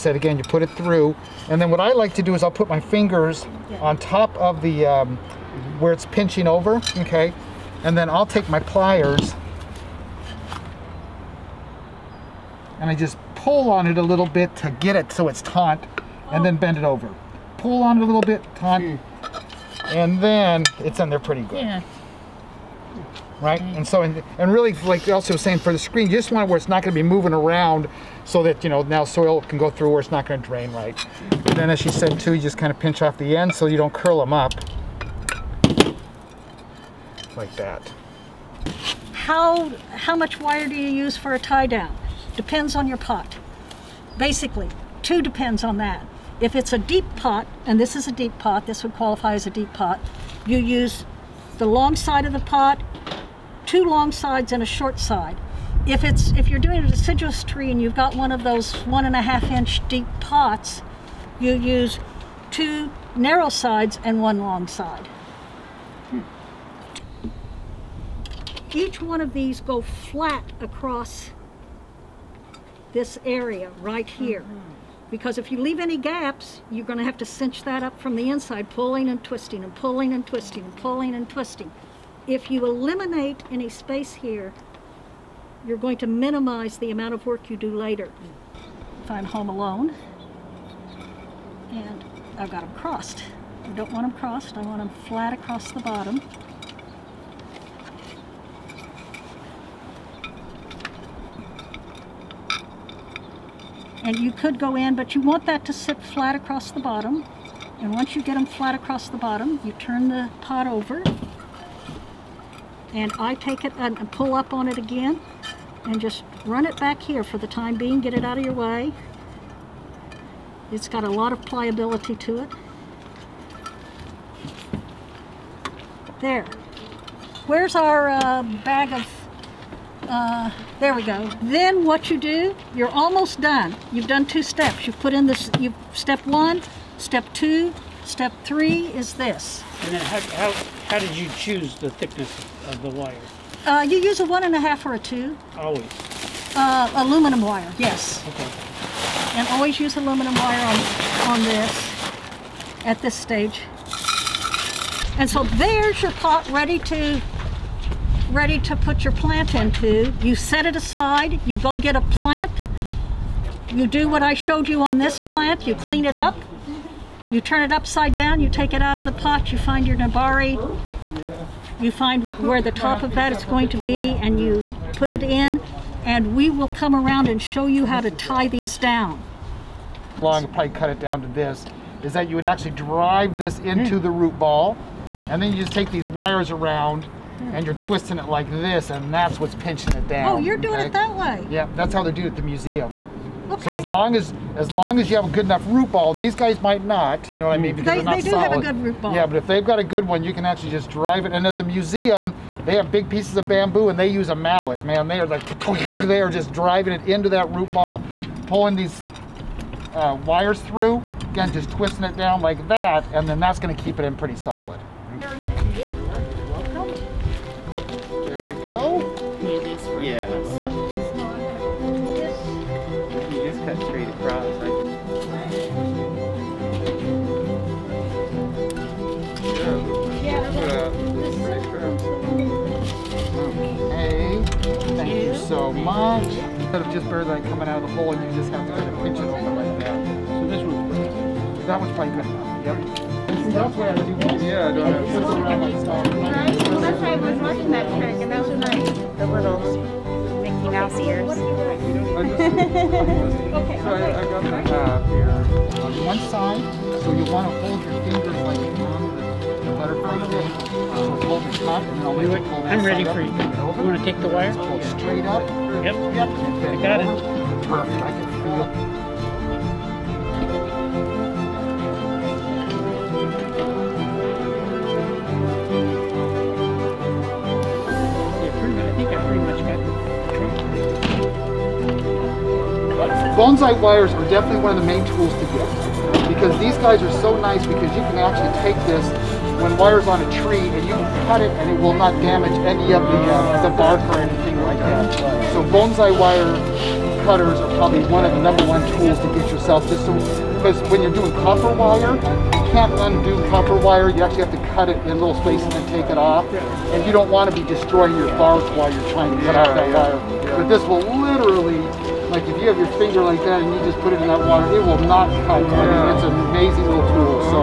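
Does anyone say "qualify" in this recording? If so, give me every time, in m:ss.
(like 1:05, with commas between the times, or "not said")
0:48.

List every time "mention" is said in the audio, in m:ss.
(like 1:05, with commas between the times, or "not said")
not said.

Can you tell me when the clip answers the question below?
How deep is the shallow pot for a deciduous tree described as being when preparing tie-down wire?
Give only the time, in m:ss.
0:58.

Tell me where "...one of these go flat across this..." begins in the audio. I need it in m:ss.
1:08.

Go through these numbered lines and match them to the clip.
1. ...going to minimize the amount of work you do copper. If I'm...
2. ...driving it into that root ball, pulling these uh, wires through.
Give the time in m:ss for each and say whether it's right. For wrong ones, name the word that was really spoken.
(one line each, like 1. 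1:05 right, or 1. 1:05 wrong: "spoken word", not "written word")
1. 1:25 wrong: "later", not "copper"
2. 3:26 right.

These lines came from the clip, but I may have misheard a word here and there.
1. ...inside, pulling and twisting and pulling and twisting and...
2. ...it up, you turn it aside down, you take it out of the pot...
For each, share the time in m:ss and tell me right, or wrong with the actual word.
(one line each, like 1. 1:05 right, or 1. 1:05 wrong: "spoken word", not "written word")
1. 1:18 right
2. 2:46 wrong: "upside", not "aside".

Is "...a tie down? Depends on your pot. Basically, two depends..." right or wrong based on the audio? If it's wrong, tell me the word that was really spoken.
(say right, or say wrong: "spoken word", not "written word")
right.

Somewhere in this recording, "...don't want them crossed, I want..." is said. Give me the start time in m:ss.
1:33.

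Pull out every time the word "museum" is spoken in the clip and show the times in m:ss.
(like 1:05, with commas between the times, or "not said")
3:12, 3:21.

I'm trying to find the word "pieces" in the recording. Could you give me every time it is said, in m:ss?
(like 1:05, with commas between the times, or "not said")
3:23.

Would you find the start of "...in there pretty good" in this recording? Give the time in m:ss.
0:20.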